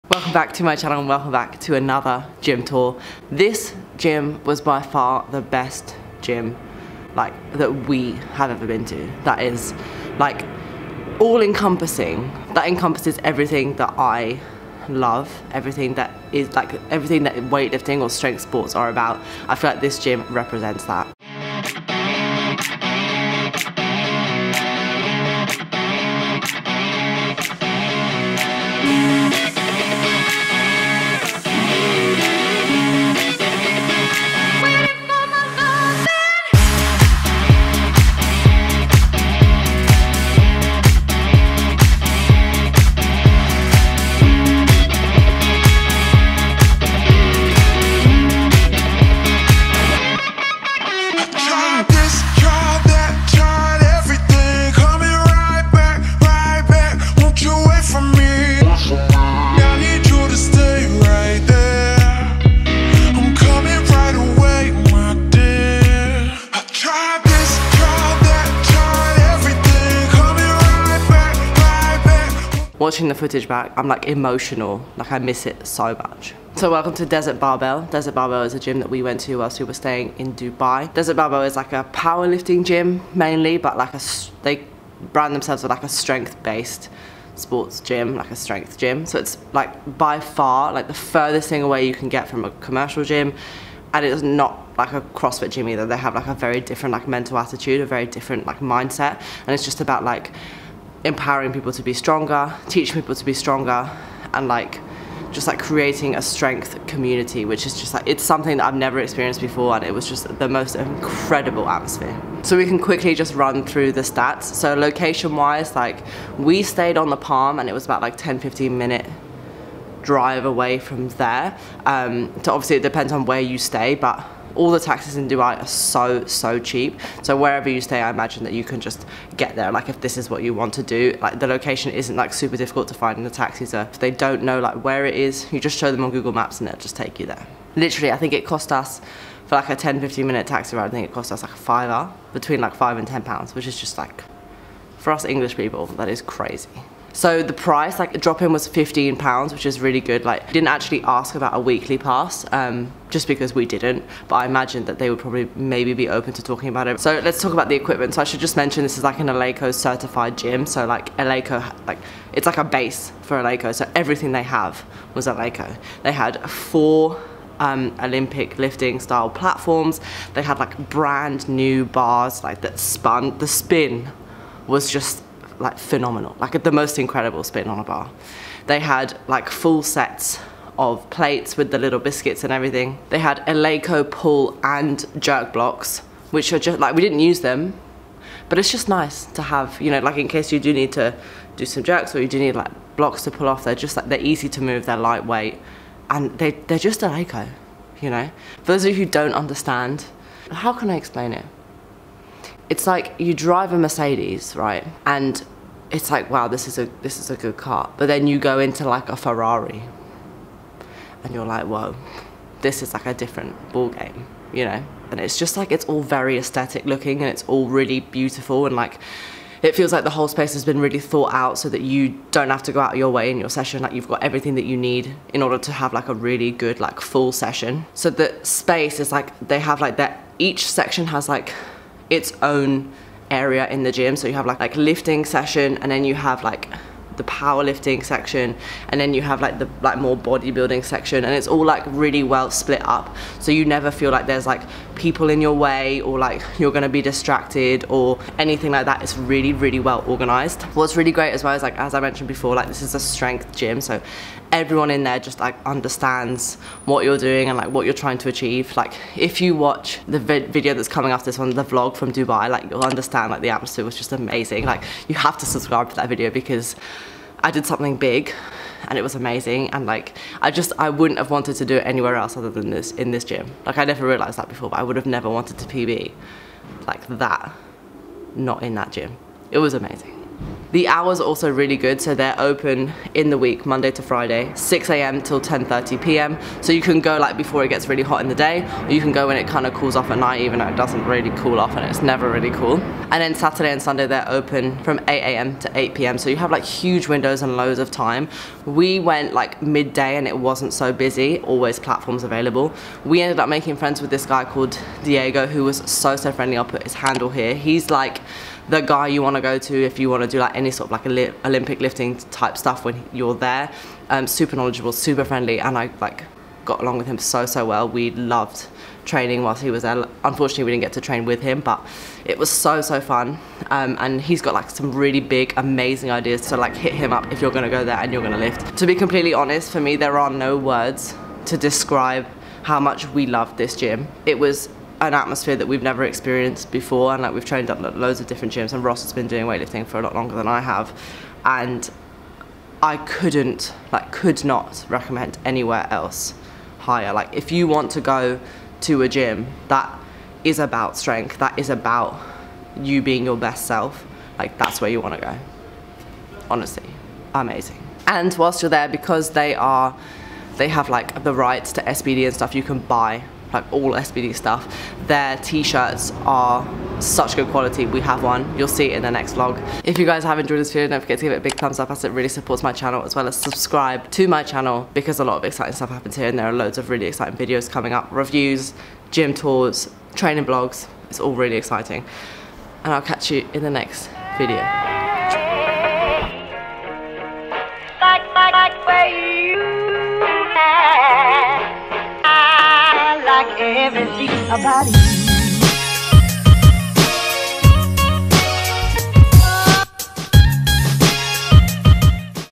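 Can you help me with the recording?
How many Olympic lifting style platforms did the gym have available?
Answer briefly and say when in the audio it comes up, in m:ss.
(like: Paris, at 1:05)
4, at 2:46.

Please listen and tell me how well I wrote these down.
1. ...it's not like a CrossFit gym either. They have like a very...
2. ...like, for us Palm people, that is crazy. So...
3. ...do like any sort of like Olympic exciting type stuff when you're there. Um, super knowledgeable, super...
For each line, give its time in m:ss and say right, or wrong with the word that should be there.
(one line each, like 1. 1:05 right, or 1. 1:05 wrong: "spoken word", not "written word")
1. 1:34 right
2. 2:23 wrong: "English", not "Palm"
3. 5:10 wrong: "lifting", not "exciting".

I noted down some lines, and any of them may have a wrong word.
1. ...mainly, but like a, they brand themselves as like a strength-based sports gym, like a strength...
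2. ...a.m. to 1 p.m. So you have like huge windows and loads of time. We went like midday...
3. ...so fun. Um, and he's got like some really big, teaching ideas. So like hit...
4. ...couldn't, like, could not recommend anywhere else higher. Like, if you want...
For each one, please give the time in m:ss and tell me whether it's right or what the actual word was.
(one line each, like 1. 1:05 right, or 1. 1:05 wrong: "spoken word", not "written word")
1. 1:23 right
2. 4:55 wrong: "8", not "1"
3. 5:22 wrong: "amazing", not "teaching"
4. 5:42 right.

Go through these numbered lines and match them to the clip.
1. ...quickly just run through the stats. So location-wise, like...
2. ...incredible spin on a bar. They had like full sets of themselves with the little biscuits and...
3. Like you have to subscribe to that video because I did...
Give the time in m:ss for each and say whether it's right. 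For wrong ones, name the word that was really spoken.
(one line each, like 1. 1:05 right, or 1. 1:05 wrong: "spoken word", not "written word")
1. 1:52 right
2. 2:56 wrong: "plates", not "themselves"
3. 4:24 right.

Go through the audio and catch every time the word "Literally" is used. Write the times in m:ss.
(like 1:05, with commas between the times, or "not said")
2:17.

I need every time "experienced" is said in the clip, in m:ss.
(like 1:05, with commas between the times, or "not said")
1:48, 5:36.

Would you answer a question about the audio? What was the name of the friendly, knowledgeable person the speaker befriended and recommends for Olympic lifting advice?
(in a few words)
Diego.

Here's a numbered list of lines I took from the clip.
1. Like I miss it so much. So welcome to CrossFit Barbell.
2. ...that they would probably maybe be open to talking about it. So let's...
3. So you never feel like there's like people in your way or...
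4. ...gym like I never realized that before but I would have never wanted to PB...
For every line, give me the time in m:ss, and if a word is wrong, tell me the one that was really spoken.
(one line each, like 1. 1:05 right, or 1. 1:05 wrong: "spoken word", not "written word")
1. 1:14 wrong: "Desert", not "CrossFit"
2. 2:34 right
3. 4:03 right
4. 4:33 right.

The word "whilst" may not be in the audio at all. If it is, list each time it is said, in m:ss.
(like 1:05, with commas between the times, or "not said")
1:19, 5:19, 5:58.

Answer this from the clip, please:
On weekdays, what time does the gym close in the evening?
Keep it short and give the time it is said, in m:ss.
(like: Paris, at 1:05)
10:30 p.m., at 4:44.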